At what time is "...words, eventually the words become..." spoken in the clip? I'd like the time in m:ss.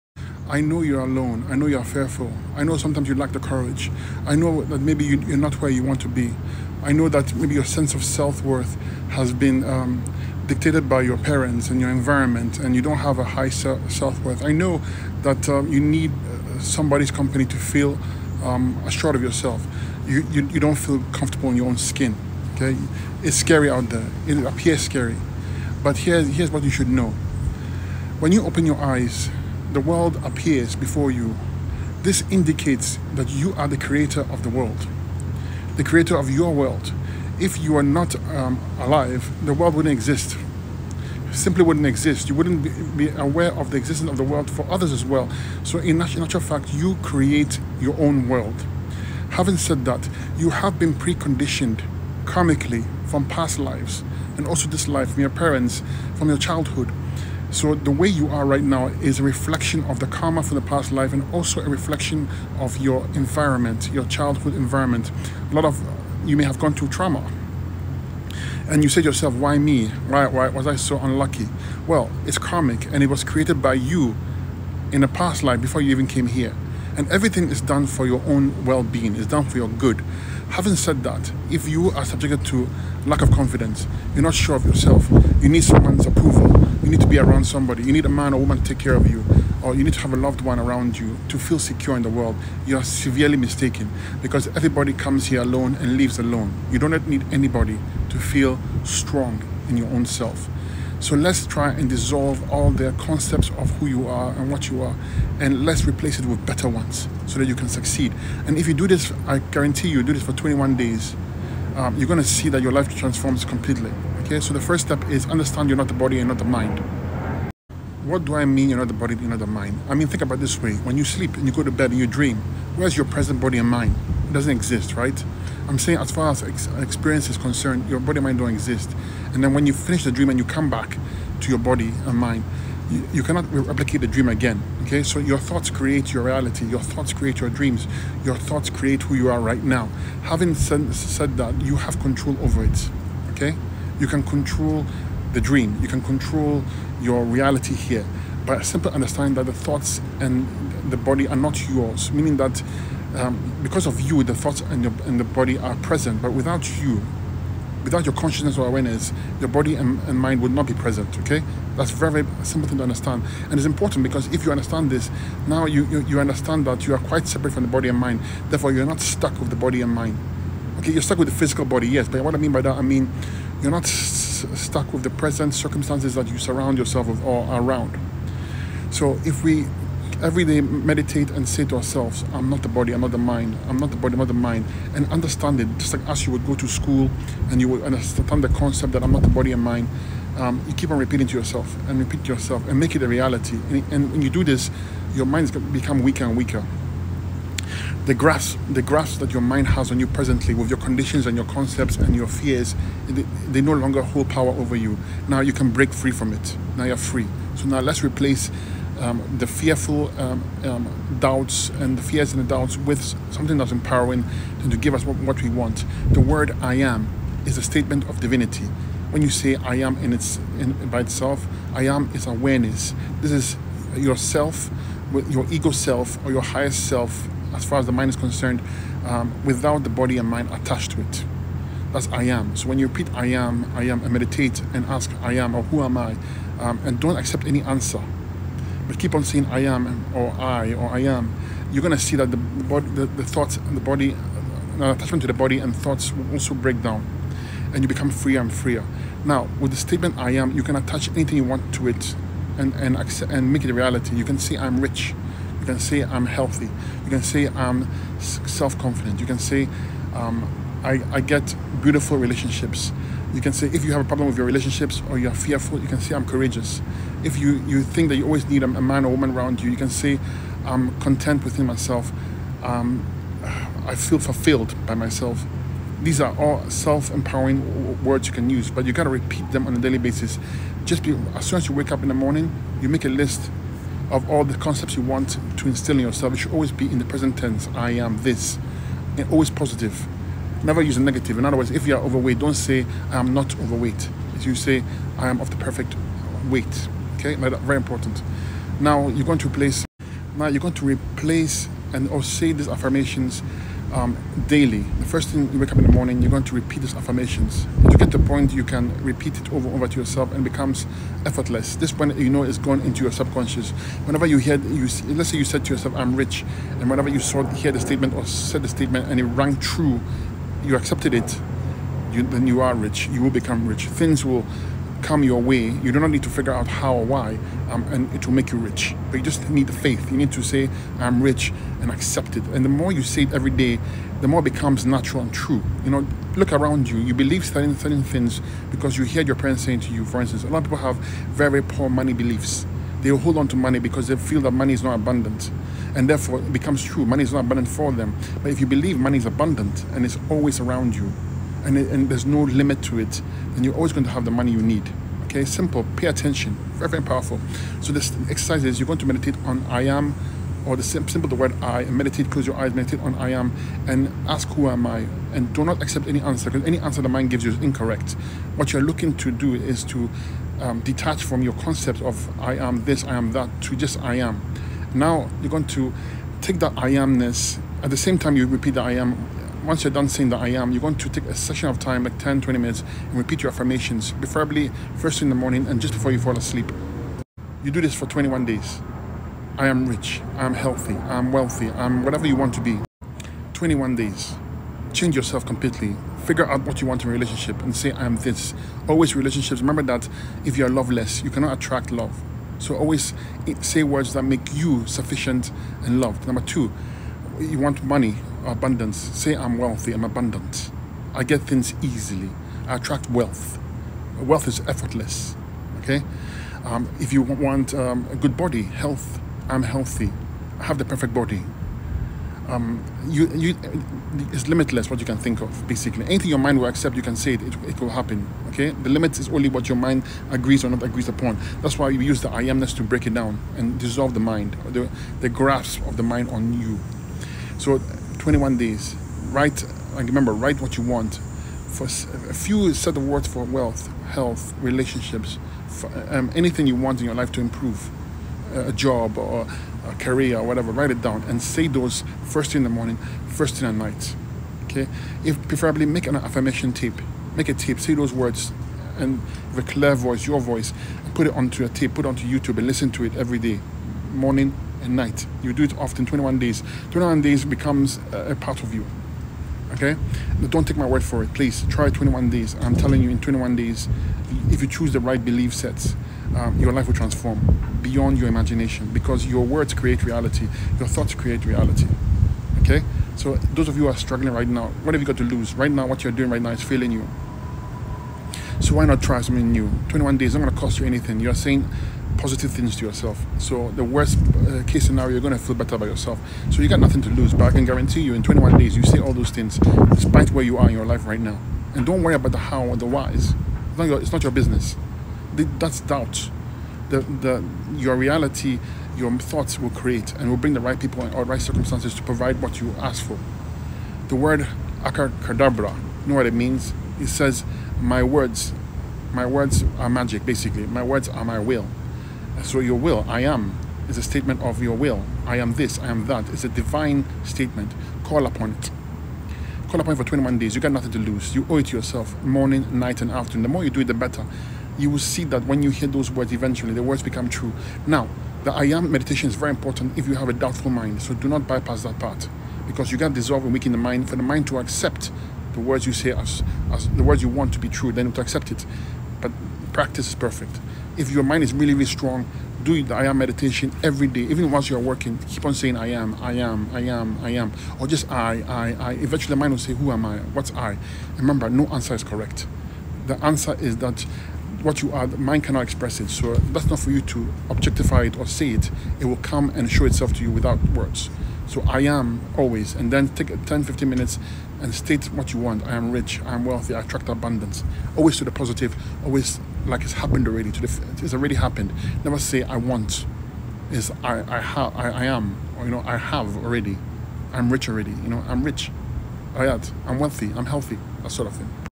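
8:56.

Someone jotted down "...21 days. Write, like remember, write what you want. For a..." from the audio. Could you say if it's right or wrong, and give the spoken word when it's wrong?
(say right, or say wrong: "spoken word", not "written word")
right.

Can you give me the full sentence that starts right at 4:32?
Um, I feel fulfilled by myself.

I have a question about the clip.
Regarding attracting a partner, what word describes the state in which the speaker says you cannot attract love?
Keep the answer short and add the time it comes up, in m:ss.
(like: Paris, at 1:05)
loveless, at 6:40.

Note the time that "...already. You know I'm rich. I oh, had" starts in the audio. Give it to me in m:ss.
9:47.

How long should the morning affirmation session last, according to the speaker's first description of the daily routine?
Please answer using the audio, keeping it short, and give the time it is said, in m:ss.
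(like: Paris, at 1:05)
10 to 20 minutes, at 6:22.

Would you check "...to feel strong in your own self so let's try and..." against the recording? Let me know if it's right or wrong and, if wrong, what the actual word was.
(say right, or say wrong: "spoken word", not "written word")
right.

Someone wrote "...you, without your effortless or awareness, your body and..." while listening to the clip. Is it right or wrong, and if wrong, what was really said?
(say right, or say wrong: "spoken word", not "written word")
wrong: "consciousness", not "effortless".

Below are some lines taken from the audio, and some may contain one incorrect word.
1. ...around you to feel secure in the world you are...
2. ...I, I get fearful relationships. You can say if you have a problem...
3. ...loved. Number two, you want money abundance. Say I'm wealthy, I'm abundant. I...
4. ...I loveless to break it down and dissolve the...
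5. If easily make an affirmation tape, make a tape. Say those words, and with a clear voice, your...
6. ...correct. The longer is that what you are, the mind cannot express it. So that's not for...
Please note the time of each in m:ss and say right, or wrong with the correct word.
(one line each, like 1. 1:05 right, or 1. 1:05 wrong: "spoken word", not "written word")
1. 1:30 right
2. 4:20 wrong: "beautiful", not "fearful"
3. 6:46 right
4. 7:12 wrong: "amness", not "loveless"
5. 7:35 wrong: "preferably", not "easily"
6. 9:22 wrong: "answer", not "longer".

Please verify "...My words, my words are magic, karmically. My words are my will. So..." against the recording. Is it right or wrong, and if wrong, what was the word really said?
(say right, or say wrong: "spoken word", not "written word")
wrong: "basically", not "karmically".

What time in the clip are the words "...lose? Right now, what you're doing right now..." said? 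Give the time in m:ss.
8:05.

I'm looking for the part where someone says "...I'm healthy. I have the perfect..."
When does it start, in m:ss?
6:59.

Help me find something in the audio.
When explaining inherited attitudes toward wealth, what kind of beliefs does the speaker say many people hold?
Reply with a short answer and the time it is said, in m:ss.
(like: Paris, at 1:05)
poor money beliefs, at 5:41.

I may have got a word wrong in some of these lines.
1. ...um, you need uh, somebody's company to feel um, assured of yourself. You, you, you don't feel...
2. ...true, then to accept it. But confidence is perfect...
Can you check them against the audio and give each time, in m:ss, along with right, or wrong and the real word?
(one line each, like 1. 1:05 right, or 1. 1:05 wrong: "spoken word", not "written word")
1. 0:15 right
2. 9:07 wrong: "practice", not "confidence".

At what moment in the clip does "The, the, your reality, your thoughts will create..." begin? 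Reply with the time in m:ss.
8:26.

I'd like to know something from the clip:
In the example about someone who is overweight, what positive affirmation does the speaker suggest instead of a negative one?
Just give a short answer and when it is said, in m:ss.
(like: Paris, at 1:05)
I am of the perfect weight, at 4:55.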